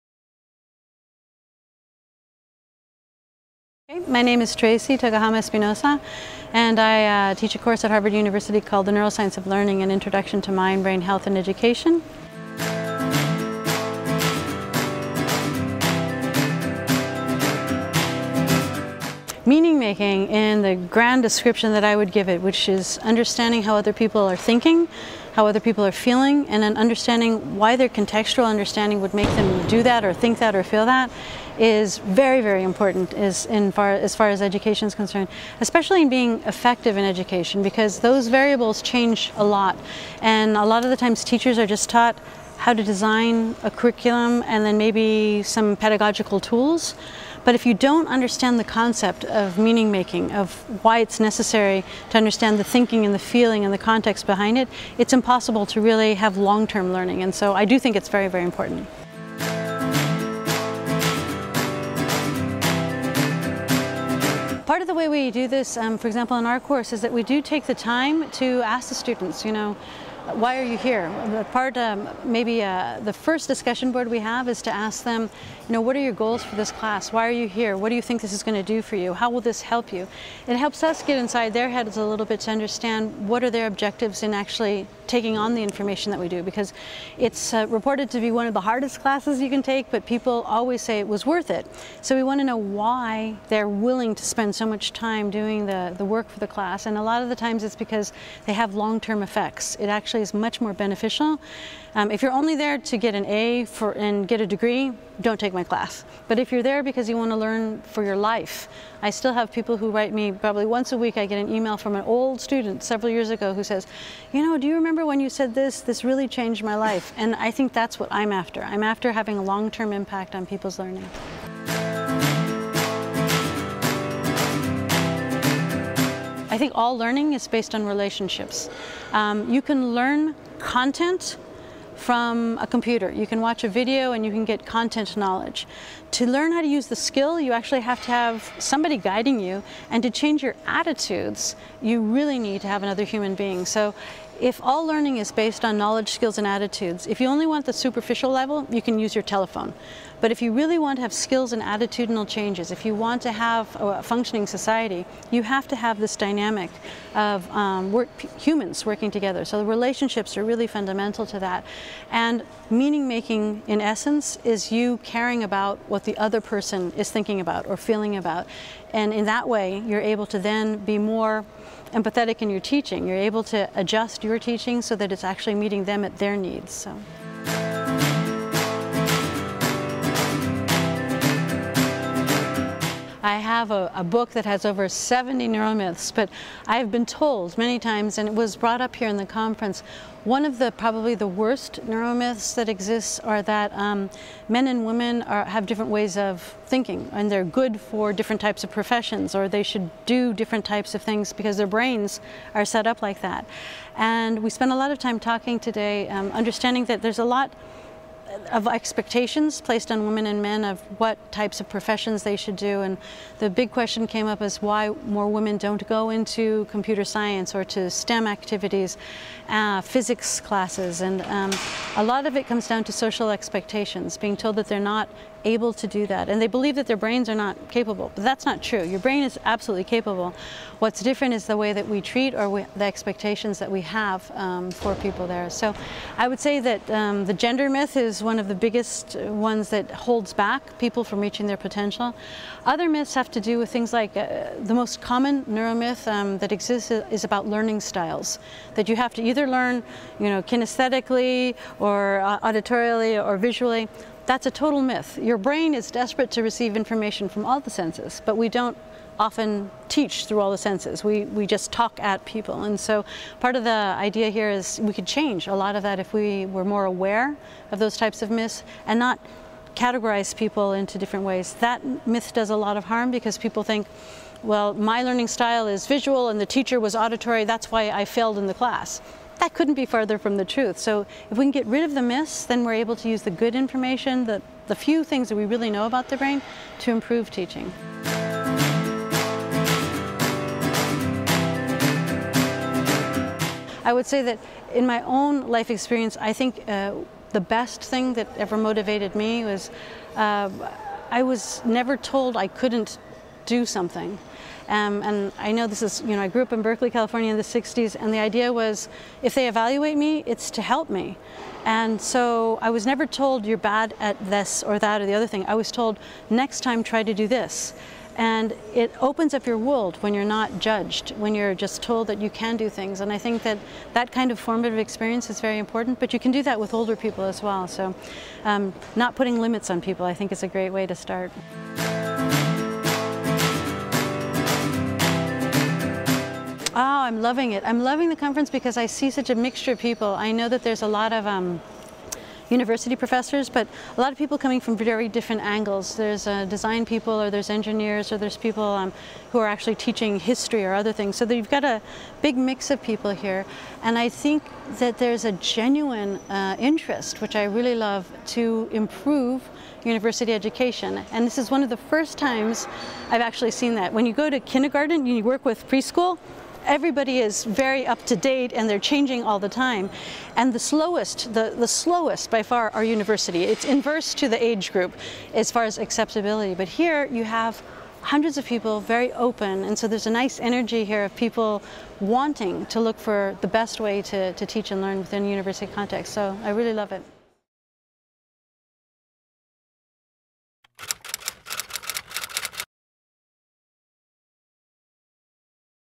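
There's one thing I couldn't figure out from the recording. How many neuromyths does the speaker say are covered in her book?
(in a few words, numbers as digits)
over 70.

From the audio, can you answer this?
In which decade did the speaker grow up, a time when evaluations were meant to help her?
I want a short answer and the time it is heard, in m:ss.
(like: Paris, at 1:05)
the 60s, at 5:07.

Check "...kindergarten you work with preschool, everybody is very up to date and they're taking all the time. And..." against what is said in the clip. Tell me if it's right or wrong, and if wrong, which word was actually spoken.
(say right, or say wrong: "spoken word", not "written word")
wrong: "changing", not "taking".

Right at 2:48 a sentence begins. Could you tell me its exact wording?
And in that way, you're able to then be more empathetic in your teaching.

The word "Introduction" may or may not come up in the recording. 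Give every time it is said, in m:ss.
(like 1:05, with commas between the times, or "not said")
0:09.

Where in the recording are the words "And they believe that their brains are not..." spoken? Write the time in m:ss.
3:46.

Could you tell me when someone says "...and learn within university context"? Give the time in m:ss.
6:24.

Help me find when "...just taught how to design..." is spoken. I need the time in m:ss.
0:41.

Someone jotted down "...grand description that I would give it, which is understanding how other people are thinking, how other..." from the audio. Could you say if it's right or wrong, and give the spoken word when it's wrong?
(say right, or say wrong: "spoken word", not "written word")
right.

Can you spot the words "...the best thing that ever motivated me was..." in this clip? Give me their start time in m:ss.
4:57.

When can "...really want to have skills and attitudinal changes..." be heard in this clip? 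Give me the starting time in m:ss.
2:30.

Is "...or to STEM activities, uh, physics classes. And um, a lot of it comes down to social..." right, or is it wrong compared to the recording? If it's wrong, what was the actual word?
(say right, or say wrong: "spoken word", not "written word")
right.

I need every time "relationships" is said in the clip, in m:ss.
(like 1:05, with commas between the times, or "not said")
2:07, 2:39.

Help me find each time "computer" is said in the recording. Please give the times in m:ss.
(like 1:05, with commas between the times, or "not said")
2:12, 3:36.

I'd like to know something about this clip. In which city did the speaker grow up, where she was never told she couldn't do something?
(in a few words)
Berkeley, California.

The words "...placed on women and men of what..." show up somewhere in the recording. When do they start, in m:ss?
3:29.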